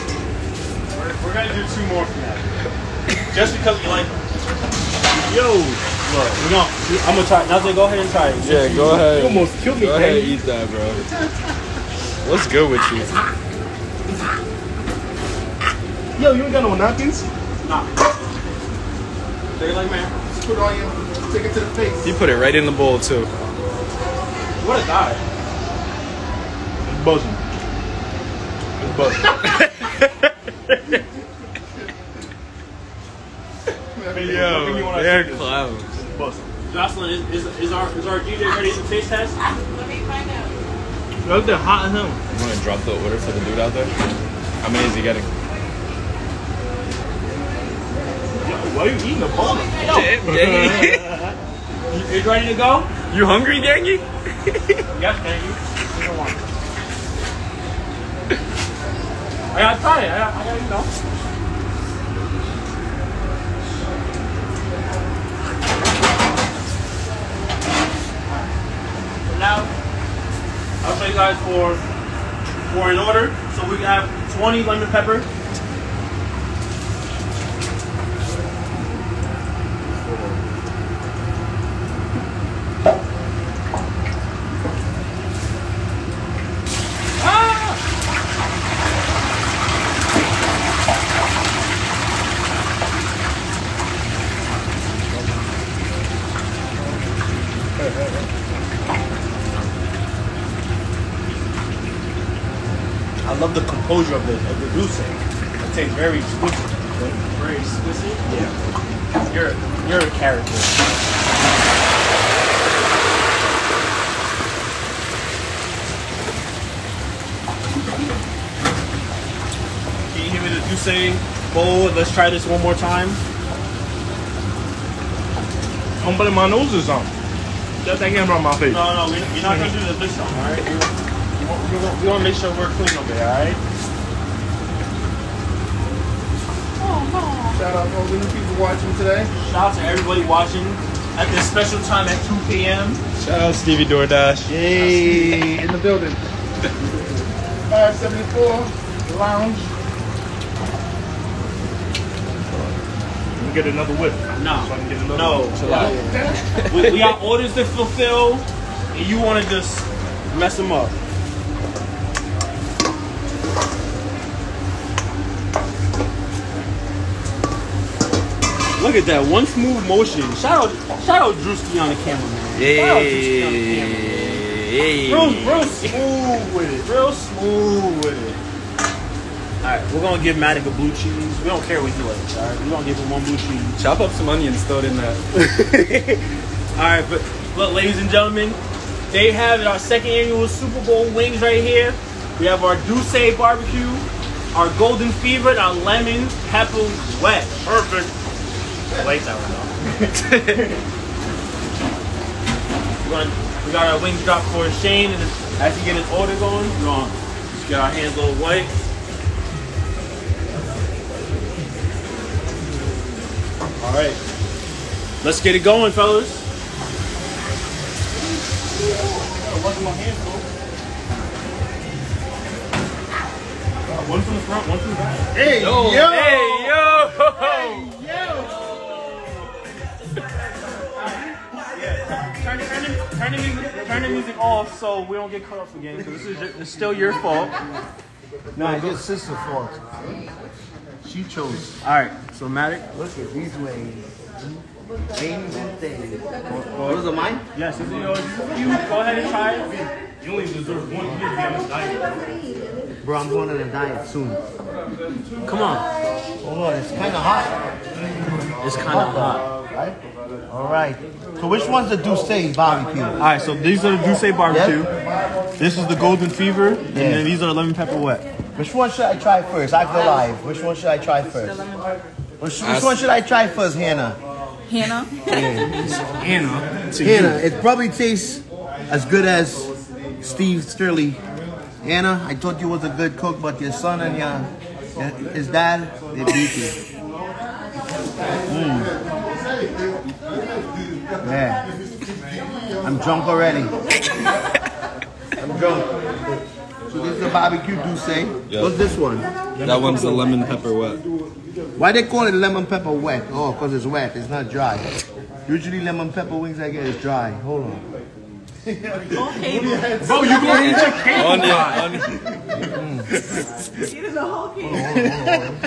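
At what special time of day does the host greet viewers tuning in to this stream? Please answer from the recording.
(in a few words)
2 p.m.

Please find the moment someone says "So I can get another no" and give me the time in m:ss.
2:34.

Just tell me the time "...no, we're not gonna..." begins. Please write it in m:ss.
2:09.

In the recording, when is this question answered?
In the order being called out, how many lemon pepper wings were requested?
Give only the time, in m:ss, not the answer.
1:14.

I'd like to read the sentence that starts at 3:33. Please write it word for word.
All right, let's get it going, fellas.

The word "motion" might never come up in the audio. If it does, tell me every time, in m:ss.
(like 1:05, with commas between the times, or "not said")
2:49.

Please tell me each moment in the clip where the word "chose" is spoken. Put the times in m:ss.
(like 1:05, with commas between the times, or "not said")
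4:01.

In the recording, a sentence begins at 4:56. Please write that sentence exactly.
So this is a barbecue D'ussé.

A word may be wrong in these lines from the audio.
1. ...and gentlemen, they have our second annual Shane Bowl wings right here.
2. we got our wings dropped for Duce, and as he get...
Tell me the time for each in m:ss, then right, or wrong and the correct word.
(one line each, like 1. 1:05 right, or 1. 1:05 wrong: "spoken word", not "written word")
1. 3:07 wrong: "Super", not "Shane"
2. 3:23 wrong: "Shane", not "Duce".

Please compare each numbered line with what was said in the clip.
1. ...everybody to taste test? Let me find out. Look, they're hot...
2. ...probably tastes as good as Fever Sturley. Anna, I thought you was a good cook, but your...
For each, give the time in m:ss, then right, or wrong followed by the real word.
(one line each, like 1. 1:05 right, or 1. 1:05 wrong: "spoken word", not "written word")
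1. 0:38 wrong: "ready", not "everybody"
2. 4:37 wrong: "Steve", not "Fever".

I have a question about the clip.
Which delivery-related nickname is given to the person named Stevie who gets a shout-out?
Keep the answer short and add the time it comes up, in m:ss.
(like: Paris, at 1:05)
Stevie DoorDash, at 2:23.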